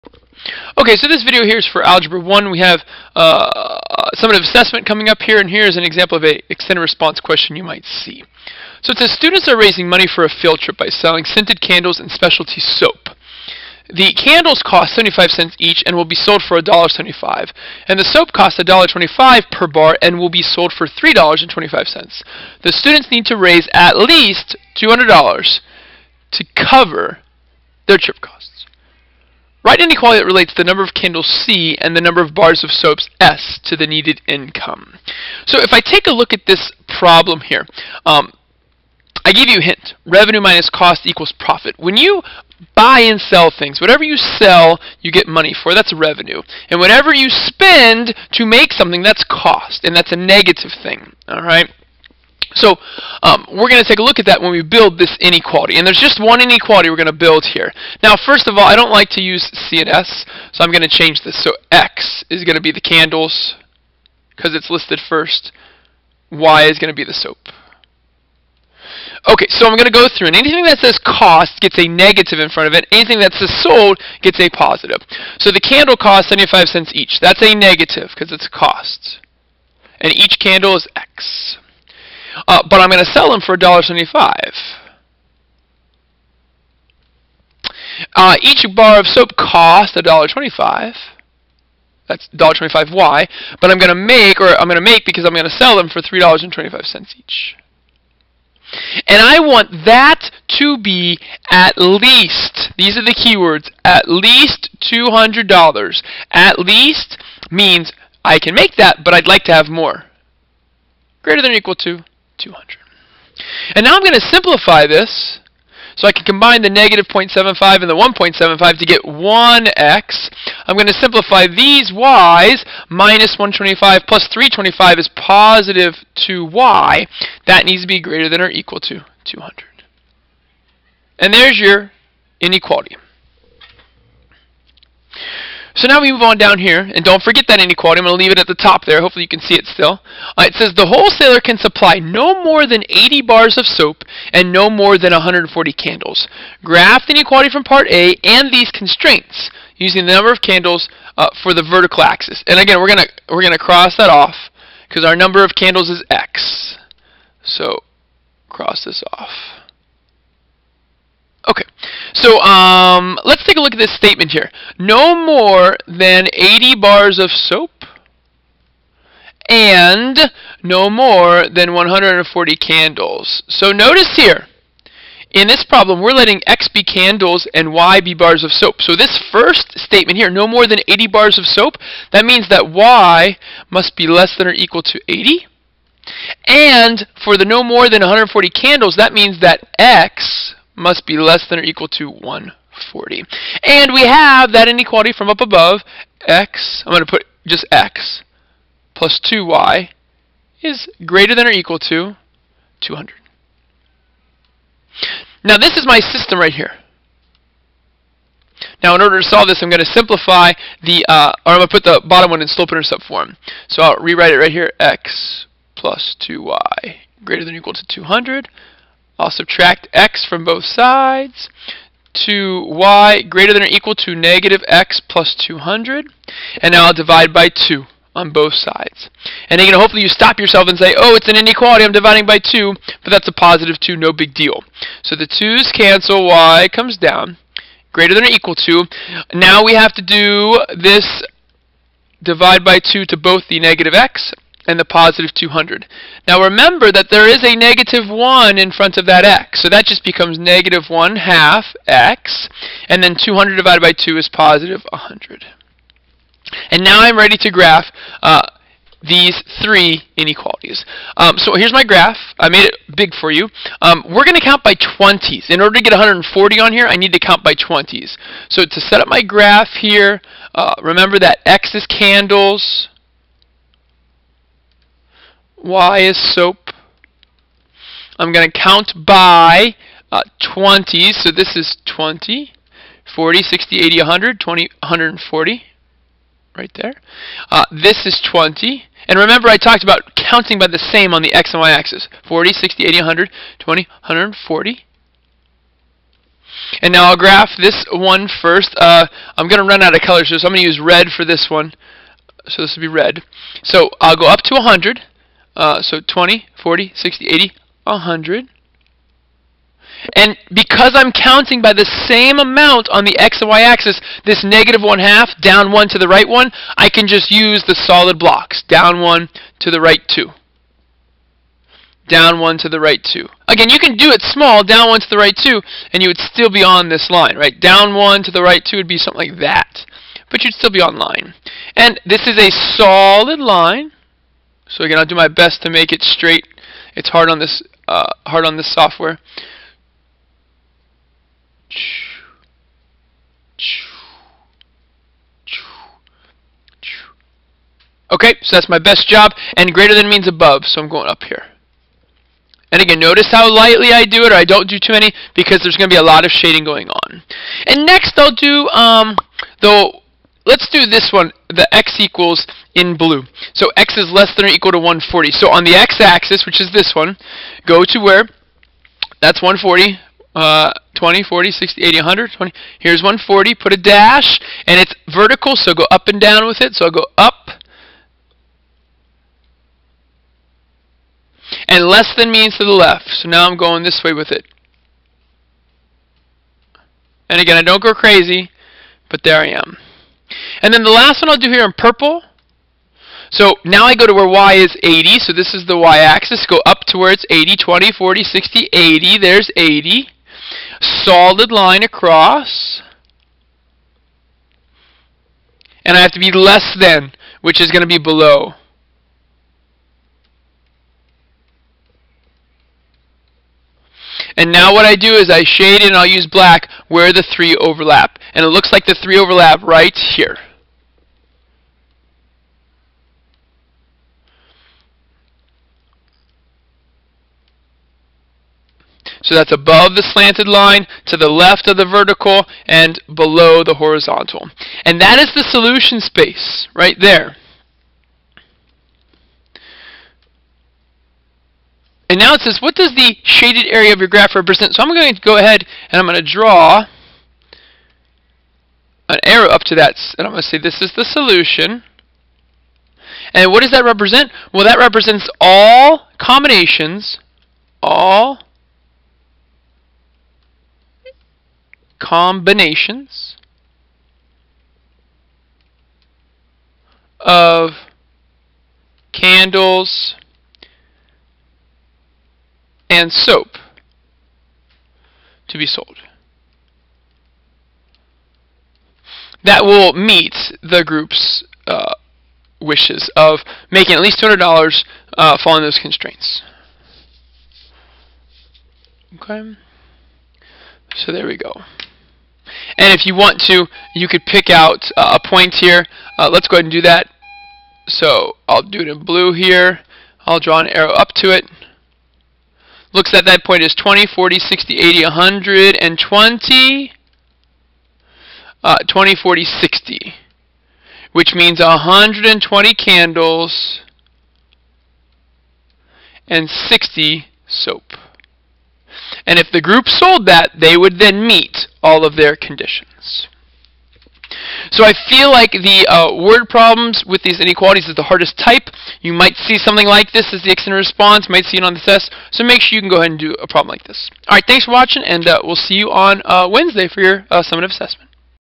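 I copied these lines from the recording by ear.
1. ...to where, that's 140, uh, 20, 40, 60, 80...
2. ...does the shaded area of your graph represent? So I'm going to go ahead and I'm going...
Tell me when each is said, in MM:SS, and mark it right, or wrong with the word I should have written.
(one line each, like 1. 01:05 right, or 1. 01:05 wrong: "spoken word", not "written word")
1. 06:07 right
2. 07:22 right.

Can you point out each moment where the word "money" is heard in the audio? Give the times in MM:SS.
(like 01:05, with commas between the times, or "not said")
00:09, 00:45.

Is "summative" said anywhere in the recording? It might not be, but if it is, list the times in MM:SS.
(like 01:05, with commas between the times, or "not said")
00:04, 08:57.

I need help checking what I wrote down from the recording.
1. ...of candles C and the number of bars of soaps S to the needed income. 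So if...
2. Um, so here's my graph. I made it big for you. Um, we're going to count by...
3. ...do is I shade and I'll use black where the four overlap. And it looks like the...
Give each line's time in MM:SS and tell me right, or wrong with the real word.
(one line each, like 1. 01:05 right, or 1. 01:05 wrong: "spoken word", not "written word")
1. 00:30 right
2. 04:21 right
3. 06:54 wrong: "three", not "four".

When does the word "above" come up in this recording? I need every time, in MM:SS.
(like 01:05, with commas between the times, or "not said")
03:15, 05:50, 07:09.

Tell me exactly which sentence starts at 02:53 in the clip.
So notice here, in this problem, we're letting X be candles and Y be bars of soap.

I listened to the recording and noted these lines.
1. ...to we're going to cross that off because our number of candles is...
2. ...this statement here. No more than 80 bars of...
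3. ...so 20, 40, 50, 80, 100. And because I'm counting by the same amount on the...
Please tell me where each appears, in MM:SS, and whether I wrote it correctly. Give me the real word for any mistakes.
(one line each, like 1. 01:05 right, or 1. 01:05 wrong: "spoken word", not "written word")
1. 02:32 right
2. 02:43 right
3. 05:05 wrong: "60", not "50".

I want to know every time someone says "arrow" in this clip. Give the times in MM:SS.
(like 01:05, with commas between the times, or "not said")
07:29, 08:20.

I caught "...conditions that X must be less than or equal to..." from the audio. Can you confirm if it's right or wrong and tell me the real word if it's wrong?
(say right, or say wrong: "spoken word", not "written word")
wrong: "means", not "conditions".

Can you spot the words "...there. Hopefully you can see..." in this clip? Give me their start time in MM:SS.
02:18.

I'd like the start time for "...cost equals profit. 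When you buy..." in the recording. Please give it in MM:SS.
00:40.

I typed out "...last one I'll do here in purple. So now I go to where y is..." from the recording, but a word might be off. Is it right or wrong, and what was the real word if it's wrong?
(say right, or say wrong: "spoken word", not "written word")
right.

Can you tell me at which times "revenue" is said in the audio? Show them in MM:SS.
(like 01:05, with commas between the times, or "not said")
00:40, 00:45.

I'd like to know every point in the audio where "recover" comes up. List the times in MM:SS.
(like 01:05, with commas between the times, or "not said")
not said.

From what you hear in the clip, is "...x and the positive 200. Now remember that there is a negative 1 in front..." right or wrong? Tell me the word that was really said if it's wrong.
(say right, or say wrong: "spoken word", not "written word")
right.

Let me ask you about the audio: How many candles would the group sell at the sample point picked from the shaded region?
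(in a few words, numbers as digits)
120.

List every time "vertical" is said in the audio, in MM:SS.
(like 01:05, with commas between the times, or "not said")
02:31, 06:15, 07:11.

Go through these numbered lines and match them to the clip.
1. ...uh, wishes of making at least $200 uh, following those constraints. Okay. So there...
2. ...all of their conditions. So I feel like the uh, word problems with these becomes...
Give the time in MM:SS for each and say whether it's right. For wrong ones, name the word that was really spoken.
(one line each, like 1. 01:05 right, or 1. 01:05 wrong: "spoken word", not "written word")
1. 08:01 right
2. 08:41 wrong: "inequalities", not "becomes".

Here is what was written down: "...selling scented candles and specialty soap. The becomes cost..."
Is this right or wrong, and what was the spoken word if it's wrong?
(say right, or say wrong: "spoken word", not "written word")
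wrong: "candles", not "becomes".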